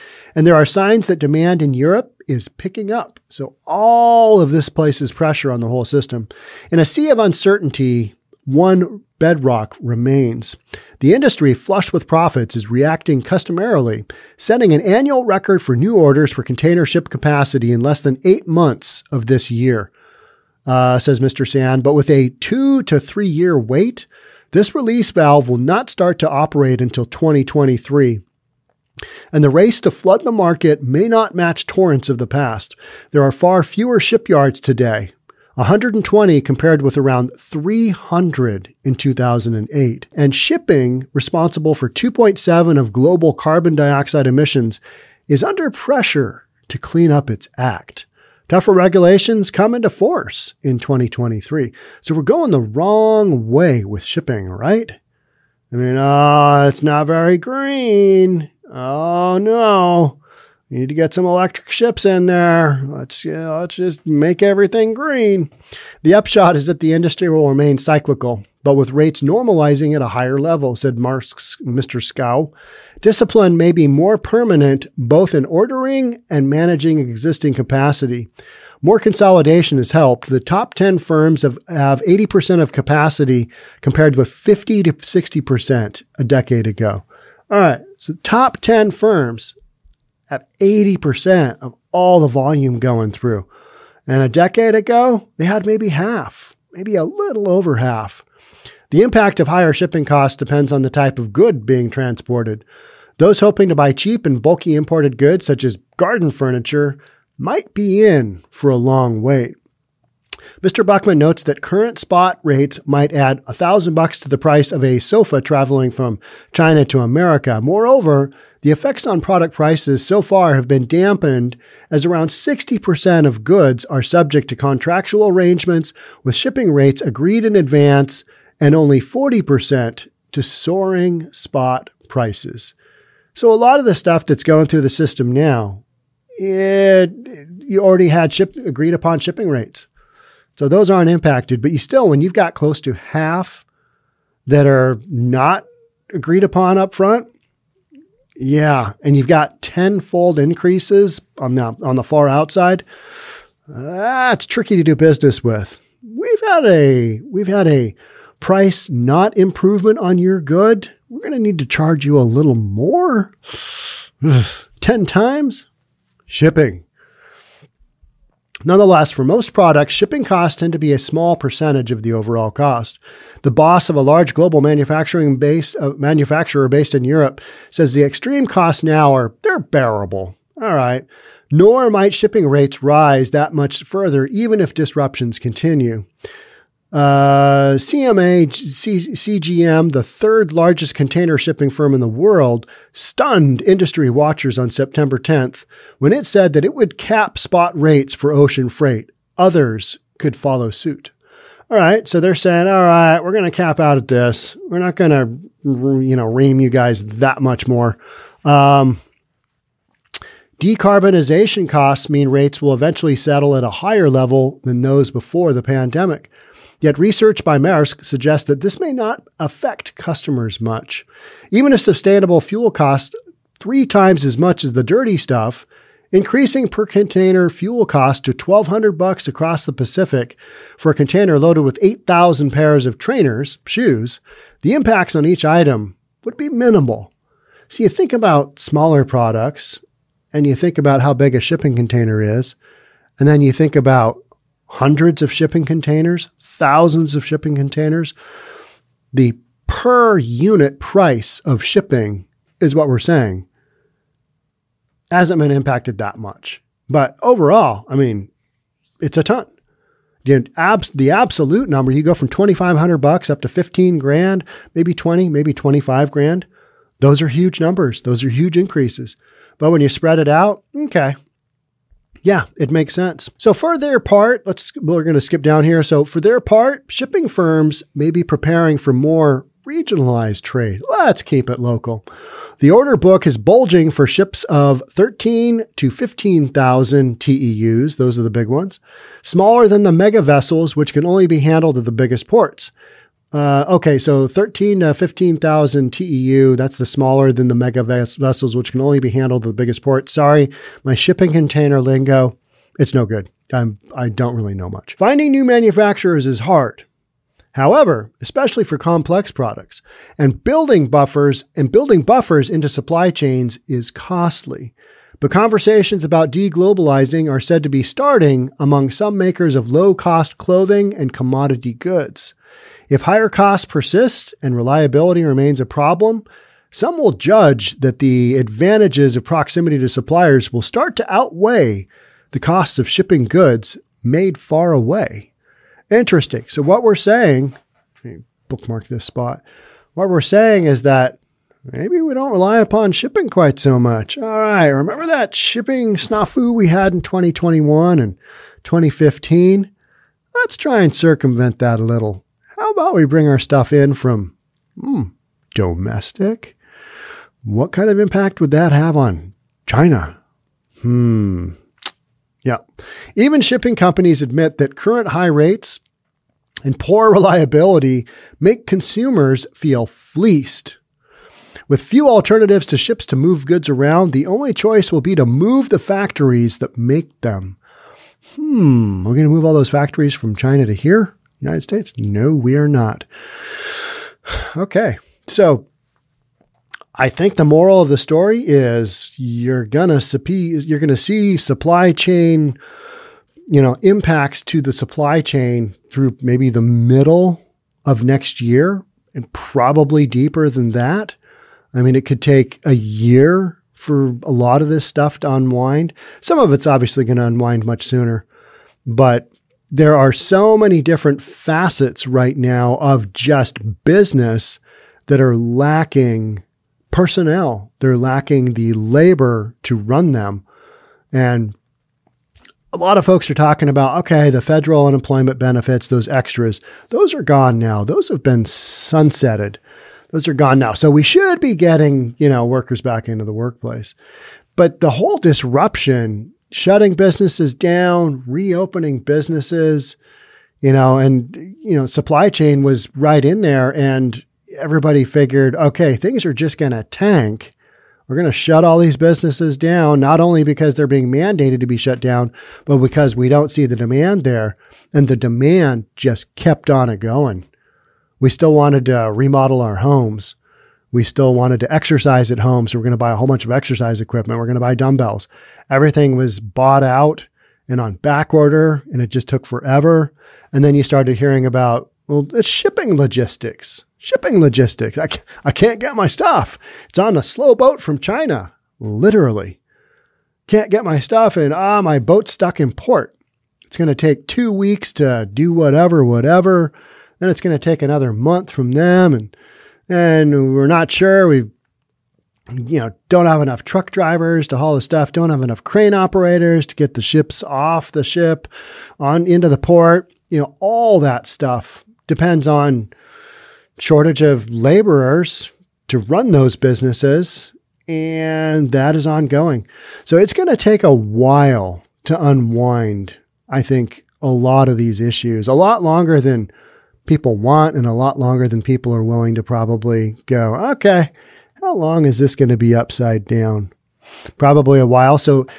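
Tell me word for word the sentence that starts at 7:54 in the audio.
I, can't, I can't get my stuff.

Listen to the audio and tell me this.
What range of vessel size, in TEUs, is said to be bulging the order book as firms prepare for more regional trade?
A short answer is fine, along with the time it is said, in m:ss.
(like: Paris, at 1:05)
13,000 to 15,000, at 4:44.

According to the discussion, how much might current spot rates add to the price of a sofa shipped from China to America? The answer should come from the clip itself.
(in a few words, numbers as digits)
$1,000.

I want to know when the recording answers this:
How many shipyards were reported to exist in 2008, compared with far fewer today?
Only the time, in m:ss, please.
0:37.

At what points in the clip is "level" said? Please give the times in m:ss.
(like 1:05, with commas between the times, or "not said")
1:10, 3:34.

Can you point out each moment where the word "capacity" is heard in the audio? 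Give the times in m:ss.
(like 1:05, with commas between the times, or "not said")
0:17, 1:17, 1:22.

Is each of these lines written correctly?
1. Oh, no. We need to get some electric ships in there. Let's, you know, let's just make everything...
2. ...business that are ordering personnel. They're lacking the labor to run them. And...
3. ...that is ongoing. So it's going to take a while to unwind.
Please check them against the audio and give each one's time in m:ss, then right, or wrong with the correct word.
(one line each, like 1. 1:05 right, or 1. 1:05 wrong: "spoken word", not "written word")
1. 0:58 right
2. 6:53 wrong: "lacking", not "ordering"
3. 8:28 right.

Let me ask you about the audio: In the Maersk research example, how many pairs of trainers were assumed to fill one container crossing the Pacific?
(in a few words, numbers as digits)
8,000.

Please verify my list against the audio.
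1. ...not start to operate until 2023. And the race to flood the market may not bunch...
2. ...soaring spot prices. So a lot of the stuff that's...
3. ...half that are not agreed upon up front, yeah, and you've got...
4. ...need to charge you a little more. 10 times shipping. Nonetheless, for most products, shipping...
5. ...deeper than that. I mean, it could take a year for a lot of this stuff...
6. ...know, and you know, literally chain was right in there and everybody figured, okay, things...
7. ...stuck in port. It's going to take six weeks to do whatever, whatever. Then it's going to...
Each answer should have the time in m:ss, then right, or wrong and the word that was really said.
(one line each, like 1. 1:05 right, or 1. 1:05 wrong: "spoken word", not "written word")
1. 0:25 wrong: "match", not "bunch"
2. 2:10 right
3. 2:22 right
4. 2:41 right
5. 6:40 right
6. 7:20 wrong: "supply", not "literally"
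7. 8:02 wrong: "two", not "six".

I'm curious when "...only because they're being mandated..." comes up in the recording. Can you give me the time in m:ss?
7:30.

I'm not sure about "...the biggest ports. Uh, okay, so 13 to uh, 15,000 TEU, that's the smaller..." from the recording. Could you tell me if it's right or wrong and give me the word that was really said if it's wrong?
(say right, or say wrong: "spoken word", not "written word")
right.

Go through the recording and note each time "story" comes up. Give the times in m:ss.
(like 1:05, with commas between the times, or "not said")
6:27.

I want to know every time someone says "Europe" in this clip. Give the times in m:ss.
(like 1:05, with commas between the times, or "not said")
0:01, 2:57.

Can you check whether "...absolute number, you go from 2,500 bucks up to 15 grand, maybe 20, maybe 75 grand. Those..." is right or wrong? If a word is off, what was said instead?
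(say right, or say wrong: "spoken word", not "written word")
wrong: "25", not "75".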